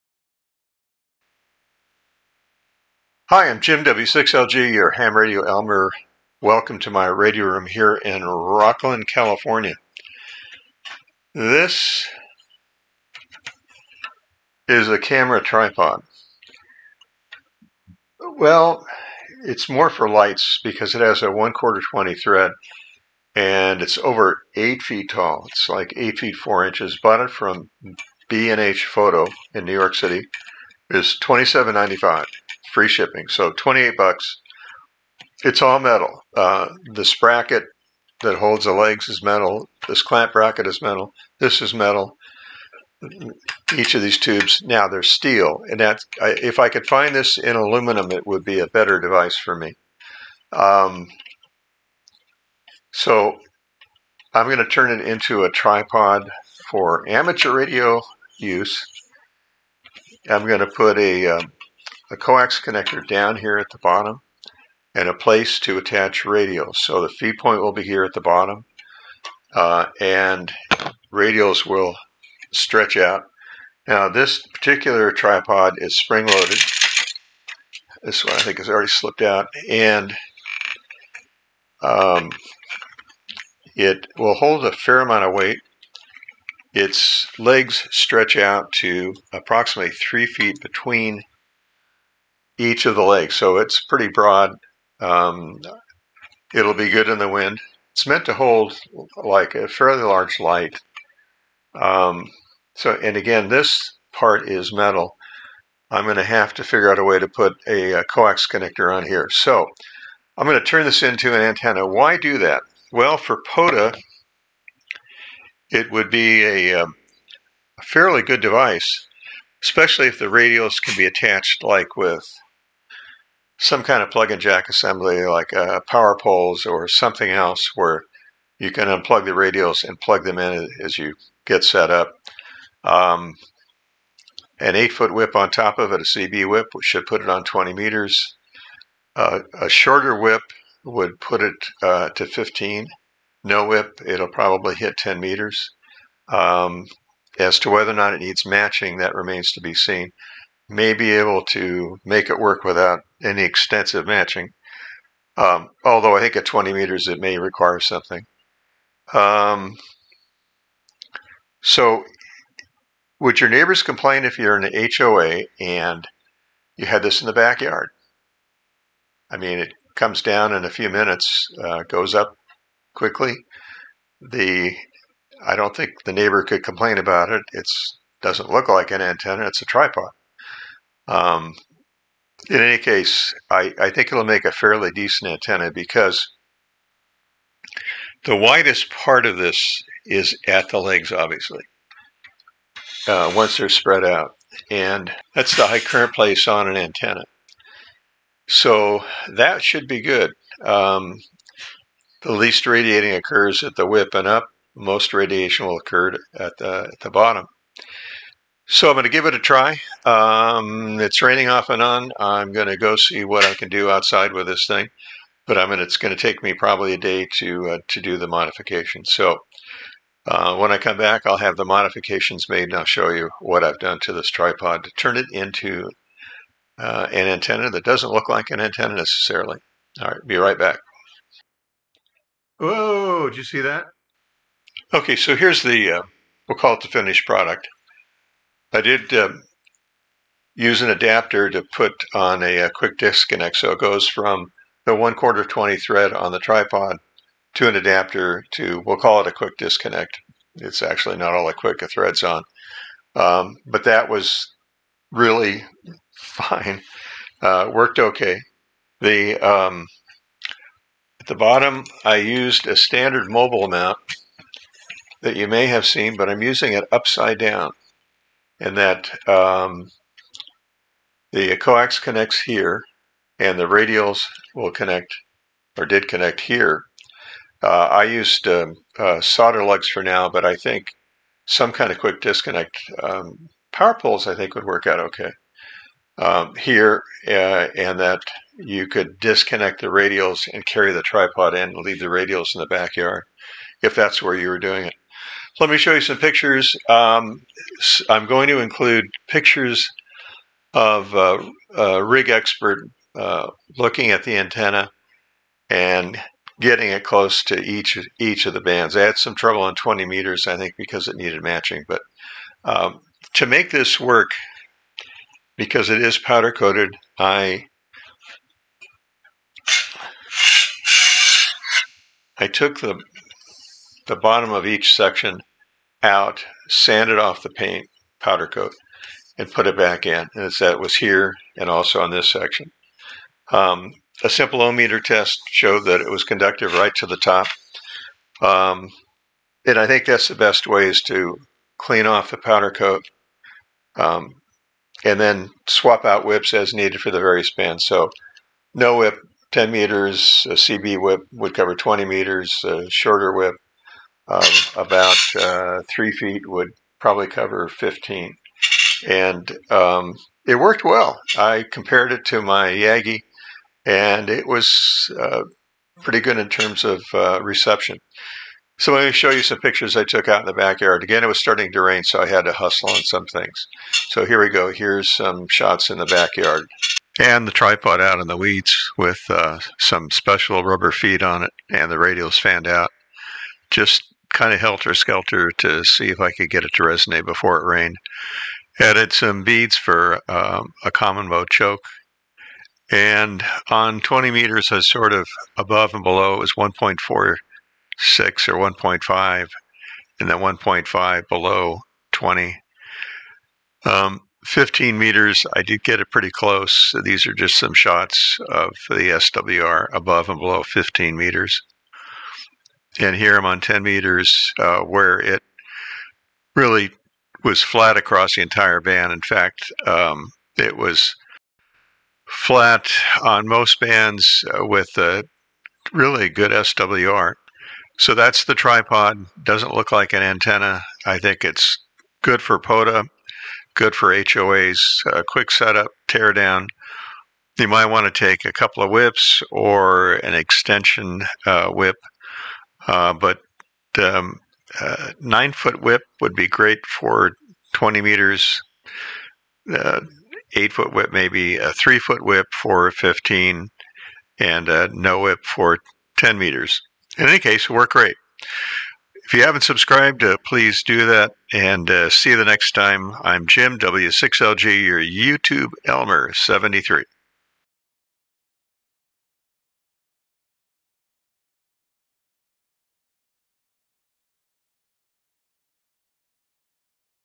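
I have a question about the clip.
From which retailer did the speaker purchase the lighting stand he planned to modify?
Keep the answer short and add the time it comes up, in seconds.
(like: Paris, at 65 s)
B&H Photo, at 28 s.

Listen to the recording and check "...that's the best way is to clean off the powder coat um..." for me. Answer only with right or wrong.
right.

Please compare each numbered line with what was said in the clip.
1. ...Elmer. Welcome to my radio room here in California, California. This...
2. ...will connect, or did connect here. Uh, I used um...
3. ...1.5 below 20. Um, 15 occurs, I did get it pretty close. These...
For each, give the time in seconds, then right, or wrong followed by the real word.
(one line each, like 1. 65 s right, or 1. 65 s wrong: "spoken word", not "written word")
1. 5 s wrong: "Rocklin", not "California"
2. 274 s right
3. 400 s wrong: "meters", not "occurs".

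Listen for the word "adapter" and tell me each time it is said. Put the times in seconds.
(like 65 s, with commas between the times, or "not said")
240 s, 247 s.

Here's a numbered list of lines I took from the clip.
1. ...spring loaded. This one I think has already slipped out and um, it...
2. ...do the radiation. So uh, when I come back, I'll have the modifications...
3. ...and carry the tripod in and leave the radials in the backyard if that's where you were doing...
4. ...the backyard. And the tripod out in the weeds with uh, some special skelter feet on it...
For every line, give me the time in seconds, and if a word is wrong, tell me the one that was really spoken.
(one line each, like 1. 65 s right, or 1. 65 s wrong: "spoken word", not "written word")
1. 75 s right
2. 218 s wrong: "modification", not "radiation"
3. 290 s right
4. 375 s wrong: "rubber", not "skelter".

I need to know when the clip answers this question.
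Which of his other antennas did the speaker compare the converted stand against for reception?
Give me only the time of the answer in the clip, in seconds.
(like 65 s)
362 s.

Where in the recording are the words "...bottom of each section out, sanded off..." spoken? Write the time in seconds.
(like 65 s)
324 s.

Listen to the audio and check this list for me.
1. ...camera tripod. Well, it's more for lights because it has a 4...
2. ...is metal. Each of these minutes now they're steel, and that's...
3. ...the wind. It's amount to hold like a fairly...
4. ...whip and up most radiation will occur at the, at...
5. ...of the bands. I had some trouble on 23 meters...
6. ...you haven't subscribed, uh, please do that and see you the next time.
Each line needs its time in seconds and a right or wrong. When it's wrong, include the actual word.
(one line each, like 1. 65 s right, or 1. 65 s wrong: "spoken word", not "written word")
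1. 14 s wrong: "1", not "4"
2. 41 s wrong: "tubes", not "minutes"
3. 97 s wrong: "meant", not "amount"
4. 203 s right
5. 308 s wrong: "20", not "23"
6. 459 s right.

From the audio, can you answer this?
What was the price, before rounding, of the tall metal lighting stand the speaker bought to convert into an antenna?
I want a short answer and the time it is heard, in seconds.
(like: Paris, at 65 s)
$27.95, at 31 s.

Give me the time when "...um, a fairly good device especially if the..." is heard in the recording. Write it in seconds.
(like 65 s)
116 s.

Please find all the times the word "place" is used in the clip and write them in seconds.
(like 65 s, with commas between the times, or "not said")
65 s, 196 s.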